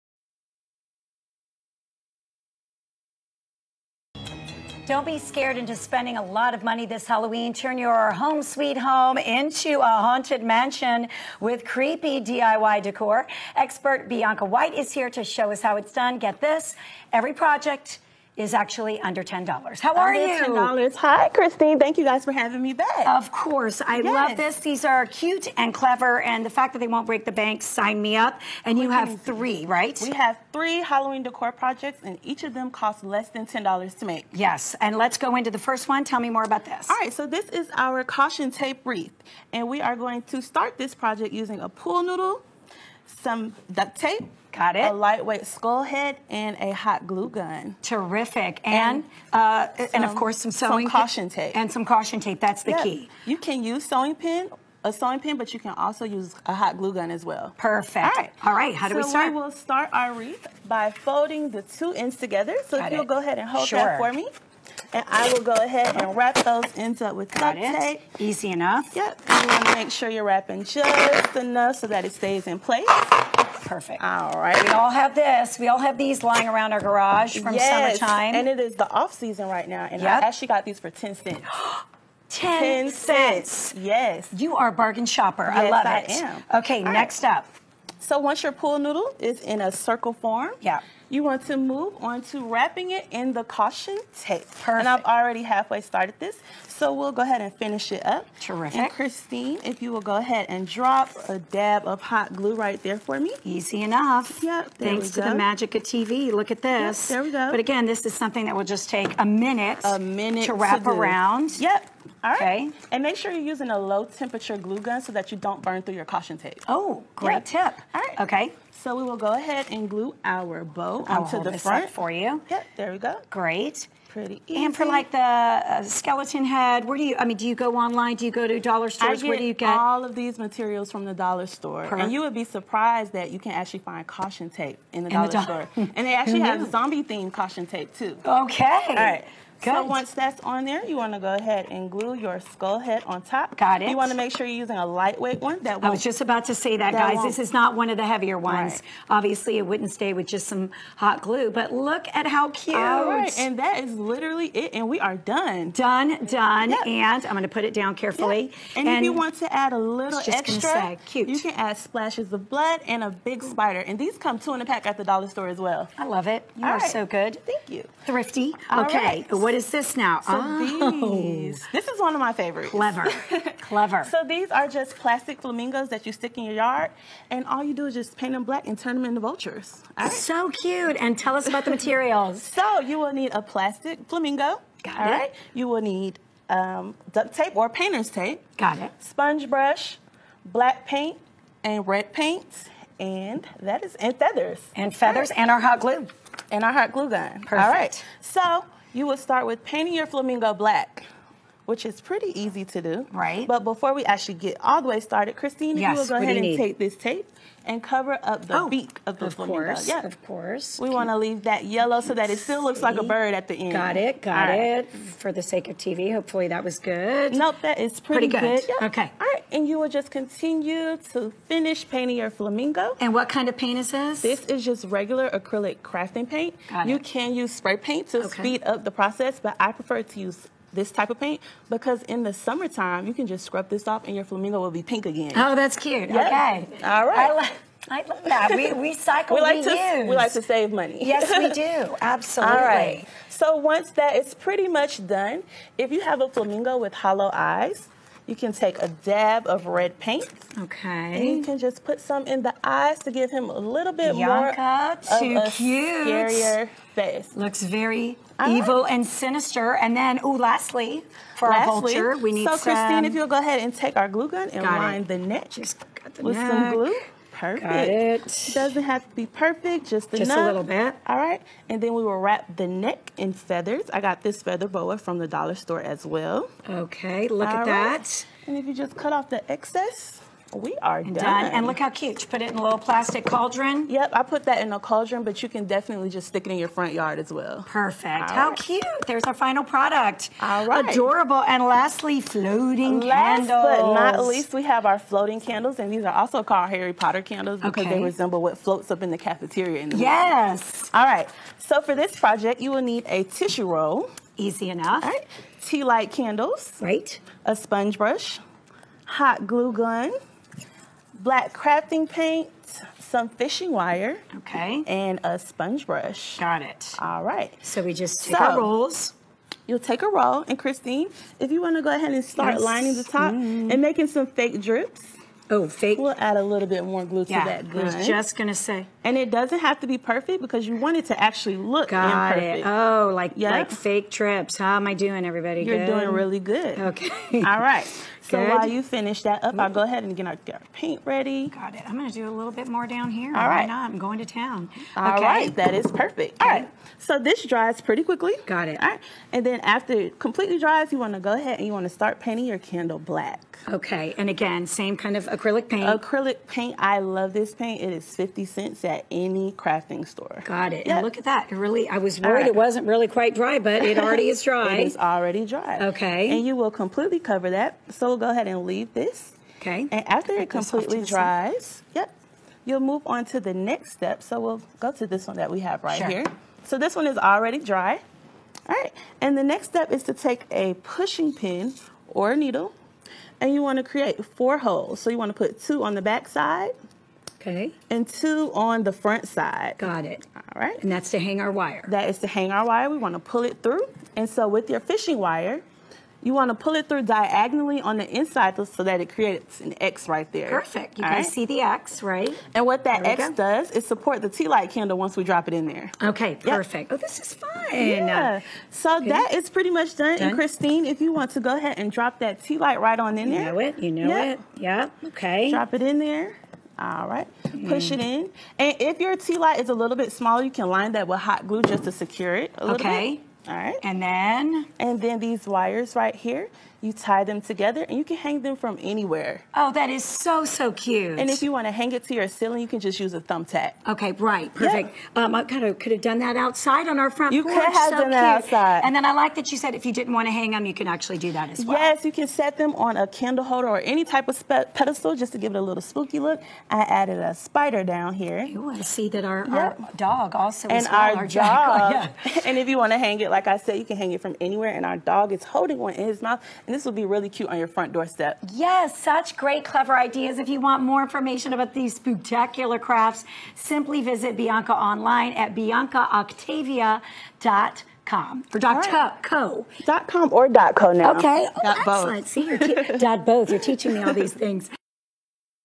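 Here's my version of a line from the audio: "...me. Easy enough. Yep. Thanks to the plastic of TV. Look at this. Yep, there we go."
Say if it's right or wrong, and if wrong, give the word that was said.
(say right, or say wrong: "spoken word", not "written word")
wrong: "magic", not "plastic".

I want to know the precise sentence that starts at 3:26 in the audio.
take this tape and cover up the oh, beak of the of flamingo.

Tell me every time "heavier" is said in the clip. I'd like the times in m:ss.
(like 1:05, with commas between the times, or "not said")
2:28.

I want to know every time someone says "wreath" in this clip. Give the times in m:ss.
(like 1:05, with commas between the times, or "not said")
0:38, 1:00.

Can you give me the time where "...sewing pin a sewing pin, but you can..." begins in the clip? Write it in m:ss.
0:53.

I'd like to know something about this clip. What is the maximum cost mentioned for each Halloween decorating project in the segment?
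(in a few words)
$10.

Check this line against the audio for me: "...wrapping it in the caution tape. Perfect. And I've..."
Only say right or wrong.
right.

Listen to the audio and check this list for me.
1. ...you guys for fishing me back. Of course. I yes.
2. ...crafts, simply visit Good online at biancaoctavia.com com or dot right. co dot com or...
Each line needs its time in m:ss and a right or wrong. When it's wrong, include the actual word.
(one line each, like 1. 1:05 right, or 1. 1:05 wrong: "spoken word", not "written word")
1. 0:21 wrong: "having", not "fishing"
2. 7:42 wrong: "Bianca", not "Good".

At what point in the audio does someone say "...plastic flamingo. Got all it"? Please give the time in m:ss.
3:03.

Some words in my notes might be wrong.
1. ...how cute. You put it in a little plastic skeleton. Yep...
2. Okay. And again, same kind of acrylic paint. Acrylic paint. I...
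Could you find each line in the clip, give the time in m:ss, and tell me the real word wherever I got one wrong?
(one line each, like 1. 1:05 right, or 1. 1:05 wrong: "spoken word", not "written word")
1. 4:41 wrong: "cauldron", not "skeleton"
2. 5:53 right.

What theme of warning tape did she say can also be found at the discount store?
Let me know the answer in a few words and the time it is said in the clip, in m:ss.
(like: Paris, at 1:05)
Zombie, at 2:16.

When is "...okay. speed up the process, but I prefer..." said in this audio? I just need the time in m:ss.
3:48.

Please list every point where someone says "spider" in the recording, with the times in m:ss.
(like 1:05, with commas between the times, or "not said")
2:43, 7:27.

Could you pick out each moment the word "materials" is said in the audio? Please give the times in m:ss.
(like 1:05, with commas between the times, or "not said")
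2:10, 3:01.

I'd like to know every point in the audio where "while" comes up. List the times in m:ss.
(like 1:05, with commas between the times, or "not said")
5:38.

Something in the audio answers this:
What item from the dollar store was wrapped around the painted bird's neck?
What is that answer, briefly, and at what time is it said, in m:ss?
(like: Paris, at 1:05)
Feather boa, at 4:34.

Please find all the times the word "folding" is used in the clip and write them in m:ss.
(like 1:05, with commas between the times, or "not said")
1:00.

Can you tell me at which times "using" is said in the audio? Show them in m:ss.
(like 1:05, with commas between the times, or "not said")
0:41, 1:53, 2:24.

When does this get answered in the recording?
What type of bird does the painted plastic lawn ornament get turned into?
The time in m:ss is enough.
2:58.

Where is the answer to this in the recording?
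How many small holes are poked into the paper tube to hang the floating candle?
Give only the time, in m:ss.
6:23.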